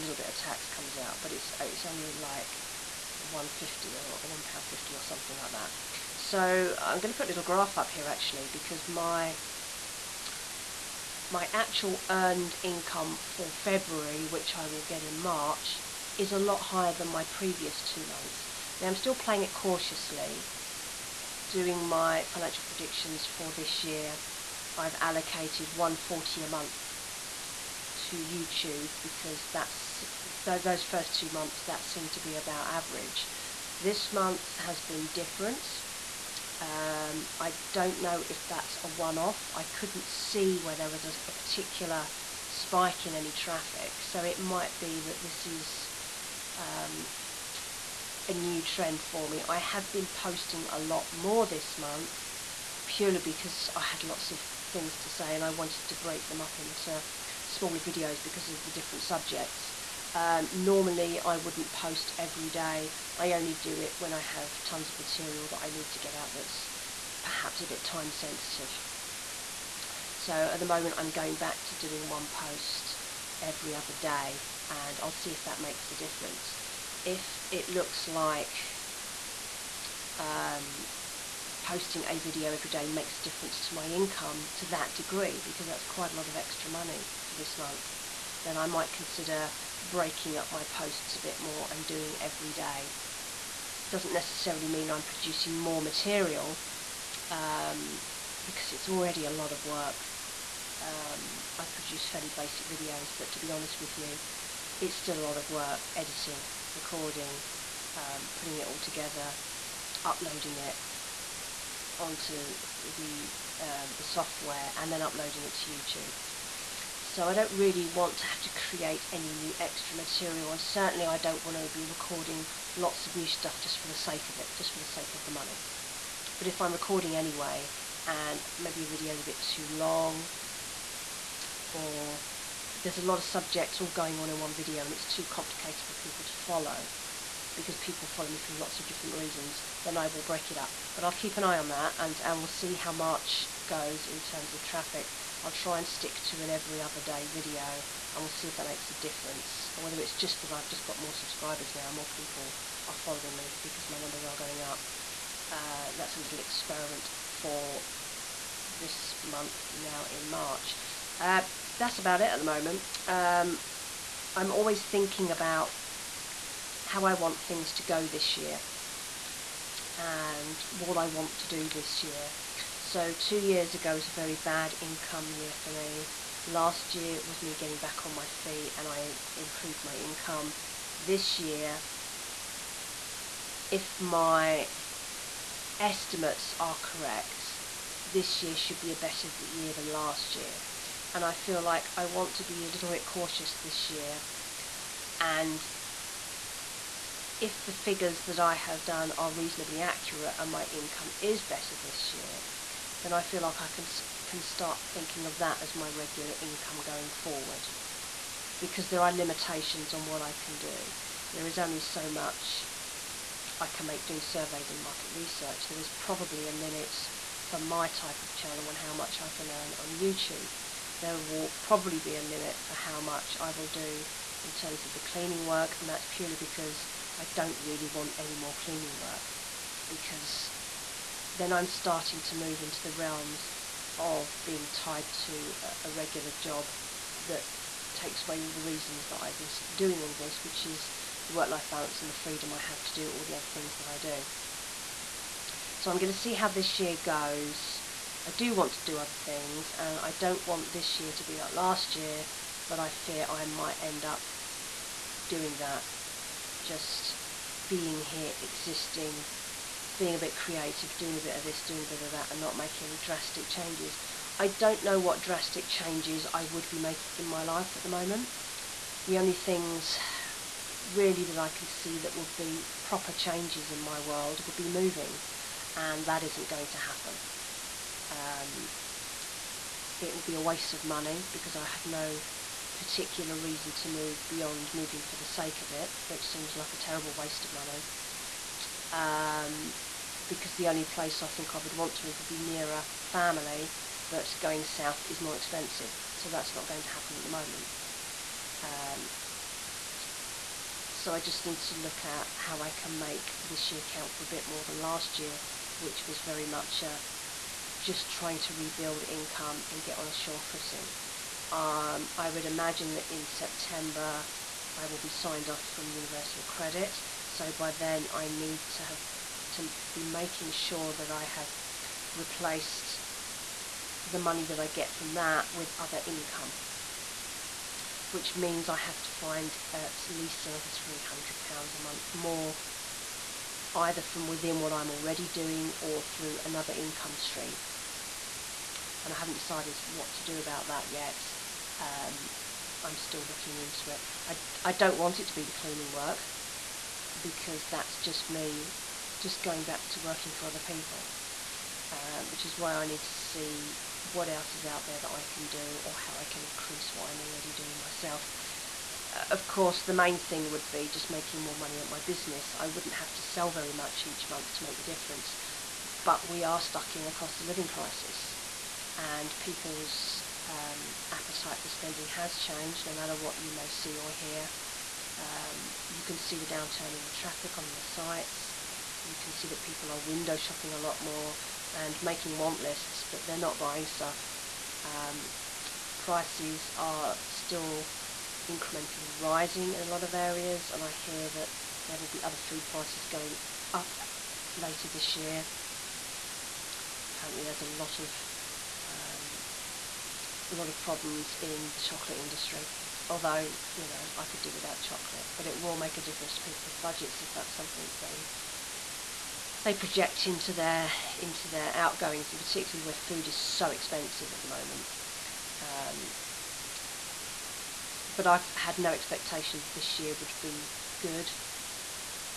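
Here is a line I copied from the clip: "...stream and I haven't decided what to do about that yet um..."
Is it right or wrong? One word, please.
right.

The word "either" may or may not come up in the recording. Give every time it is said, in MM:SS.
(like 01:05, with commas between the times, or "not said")
05:33.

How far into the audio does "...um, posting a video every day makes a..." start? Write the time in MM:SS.
01:20.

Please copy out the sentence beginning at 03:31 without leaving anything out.
There is only so much I can make doing surveys and market research.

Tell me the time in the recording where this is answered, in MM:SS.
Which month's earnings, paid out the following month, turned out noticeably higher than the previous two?
00:13.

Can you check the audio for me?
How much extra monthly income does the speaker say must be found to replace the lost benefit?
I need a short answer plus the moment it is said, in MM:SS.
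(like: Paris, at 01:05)
£300, at 05:30.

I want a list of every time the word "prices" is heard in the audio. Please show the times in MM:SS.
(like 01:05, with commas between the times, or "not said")
06:25, 06:32.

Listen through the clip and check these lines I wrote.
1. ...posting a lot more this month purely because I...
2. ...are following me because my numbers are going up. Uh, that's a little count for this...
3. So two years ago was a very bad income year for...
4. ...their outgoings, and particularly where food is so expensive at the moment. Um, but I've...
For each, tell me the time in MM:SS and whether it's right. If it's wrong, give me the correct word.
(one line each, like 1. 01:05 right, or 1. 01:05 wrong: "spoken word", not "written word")
1. 00:50 right
2. 02:32 wrong: "experiment", not "count"
3. 02:52 right
4. 06:51 right.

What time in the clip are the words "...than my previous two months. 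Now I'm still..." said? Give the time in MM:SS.
00:16.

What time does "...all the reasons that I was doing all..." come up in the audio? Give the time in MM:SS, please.
03:58.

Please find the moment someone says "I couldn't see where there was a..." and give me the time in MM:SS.
00:39.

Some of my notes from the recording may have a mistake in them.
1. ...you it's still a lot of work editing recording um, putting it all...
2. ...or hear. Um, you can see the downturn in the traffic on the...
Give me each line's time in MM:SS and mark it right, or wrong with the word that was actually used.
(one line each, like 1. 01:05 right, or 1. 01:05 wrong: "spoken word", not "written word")
1. 01:43 right
2. 06:13 right.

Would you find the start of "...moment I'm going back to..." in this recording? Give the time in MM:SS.
01:10.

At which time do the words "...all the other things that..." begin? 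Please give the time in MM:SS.
04:03.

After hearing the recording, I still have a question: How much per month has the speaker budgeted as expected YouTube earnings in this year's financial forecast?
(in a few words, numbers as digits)
140.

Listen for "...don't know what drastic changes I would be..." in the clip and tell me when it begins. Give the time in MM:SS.
04:24.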